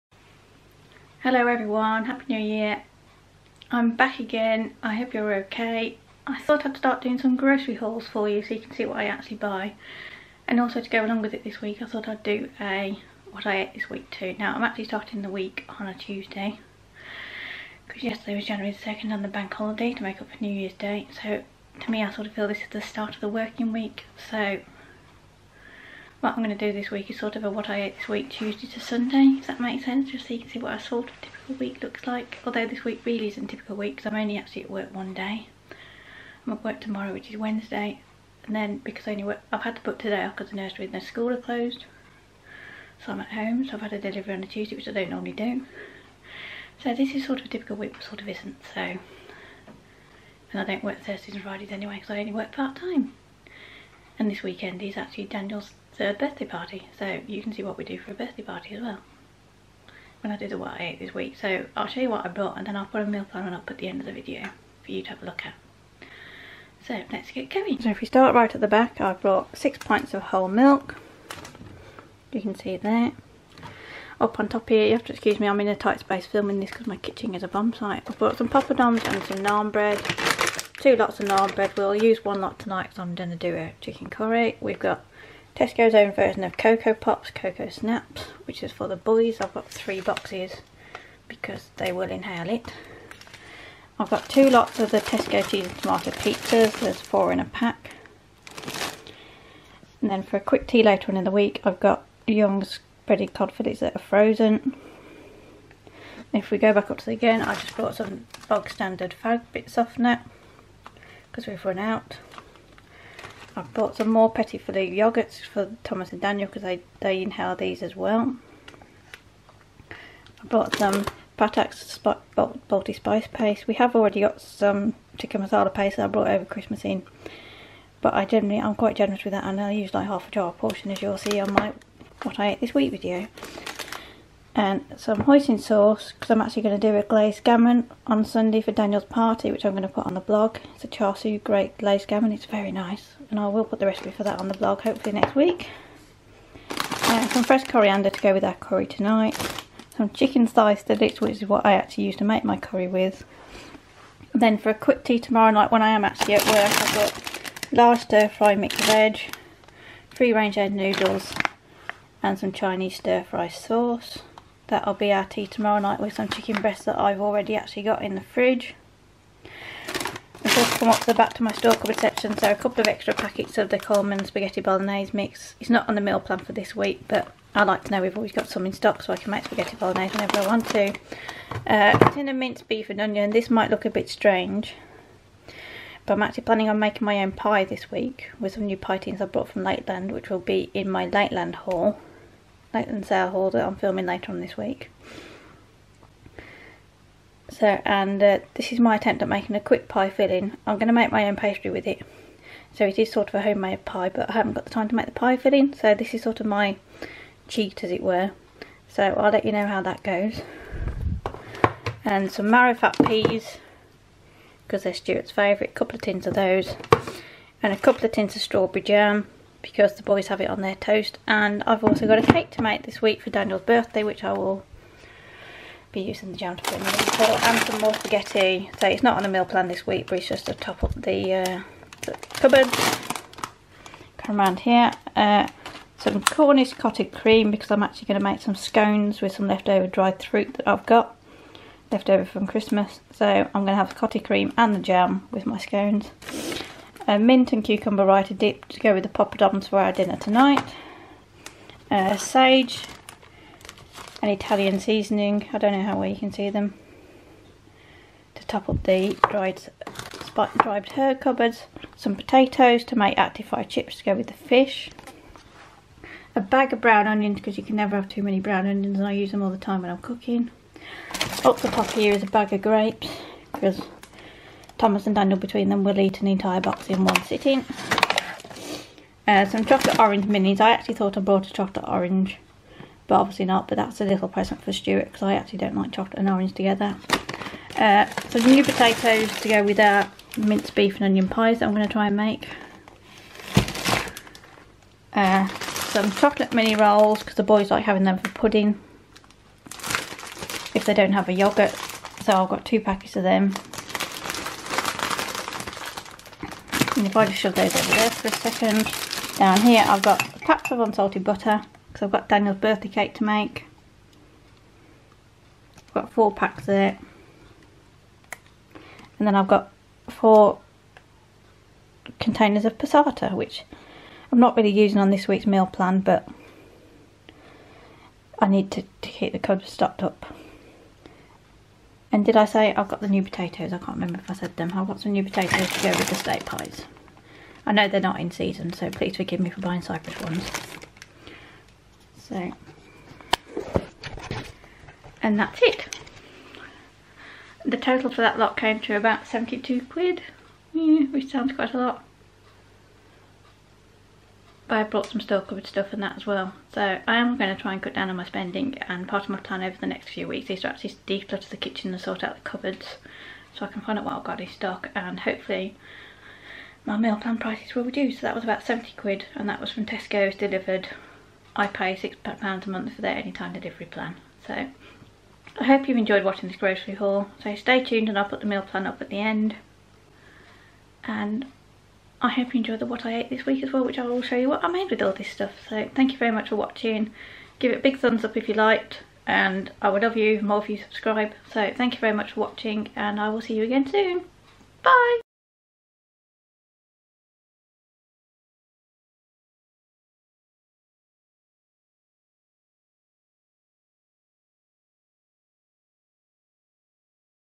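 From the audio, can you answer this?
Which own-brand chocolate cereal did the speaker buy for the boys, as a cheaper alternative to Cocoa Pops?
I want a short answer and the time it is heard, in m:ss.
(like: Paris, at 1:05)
Cocoa Snaps, at 1:27.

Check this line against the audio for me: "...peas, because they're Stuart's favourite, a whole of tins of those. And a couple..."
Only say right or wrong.
wrong.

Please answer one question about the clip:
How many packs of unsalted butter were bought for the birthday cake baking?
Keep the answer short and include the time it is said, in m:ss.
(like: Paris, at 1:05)
4, at 5:16.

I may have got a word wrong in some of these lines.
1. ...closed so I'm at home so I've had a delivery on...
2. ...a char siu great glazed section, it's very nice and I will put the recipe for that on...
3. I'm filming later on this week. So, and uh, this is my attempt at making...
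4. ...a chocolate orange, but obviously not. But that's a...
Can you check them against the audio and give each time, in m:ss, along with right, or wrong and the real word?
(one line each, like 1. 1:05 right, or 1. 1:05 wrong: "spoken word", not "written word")
1. 0:41 right
2. 2:20 wrong: "gammon", not "section"
3. 3:13 right
4. 4:41 right.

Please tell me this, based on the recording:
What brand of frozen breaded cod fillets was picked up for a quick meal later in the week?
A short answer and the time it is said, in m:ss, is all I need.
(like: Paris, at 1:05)
Young's, at 1:42.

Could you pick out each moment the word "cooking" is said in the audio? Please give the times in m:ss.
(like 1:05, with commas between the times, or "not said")
4:29.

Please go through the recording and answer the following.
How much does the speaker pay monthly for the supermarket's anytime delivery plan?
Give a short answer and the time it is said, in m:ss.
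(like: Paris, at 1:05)
£6, at 6:11.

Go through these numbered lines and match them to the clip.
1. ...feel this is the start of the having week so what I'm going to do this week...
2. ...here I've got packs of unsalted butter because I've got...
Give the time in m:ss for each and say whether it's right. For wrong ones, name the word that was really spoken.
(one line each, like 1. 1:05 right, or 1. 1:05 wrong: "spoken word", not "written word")
1. 0:22 wrong: "working", not "having"
2. 5:09 right.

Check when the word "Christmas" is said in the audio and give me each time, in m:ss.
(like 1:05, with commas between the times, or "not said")
2:06, 4:02.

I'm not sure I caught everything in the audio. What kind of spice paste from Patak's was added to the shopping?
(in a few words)
Balti.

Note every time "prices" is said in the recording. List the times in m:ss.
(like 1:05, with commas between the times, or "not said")
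6:07.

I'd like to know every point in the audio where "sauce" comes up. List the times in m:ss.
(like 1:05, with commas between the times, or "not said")
2:15, 2:43.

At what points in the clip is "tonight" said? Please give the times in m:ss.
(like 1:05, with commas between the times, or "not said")
1:22, 2:28, 4:10.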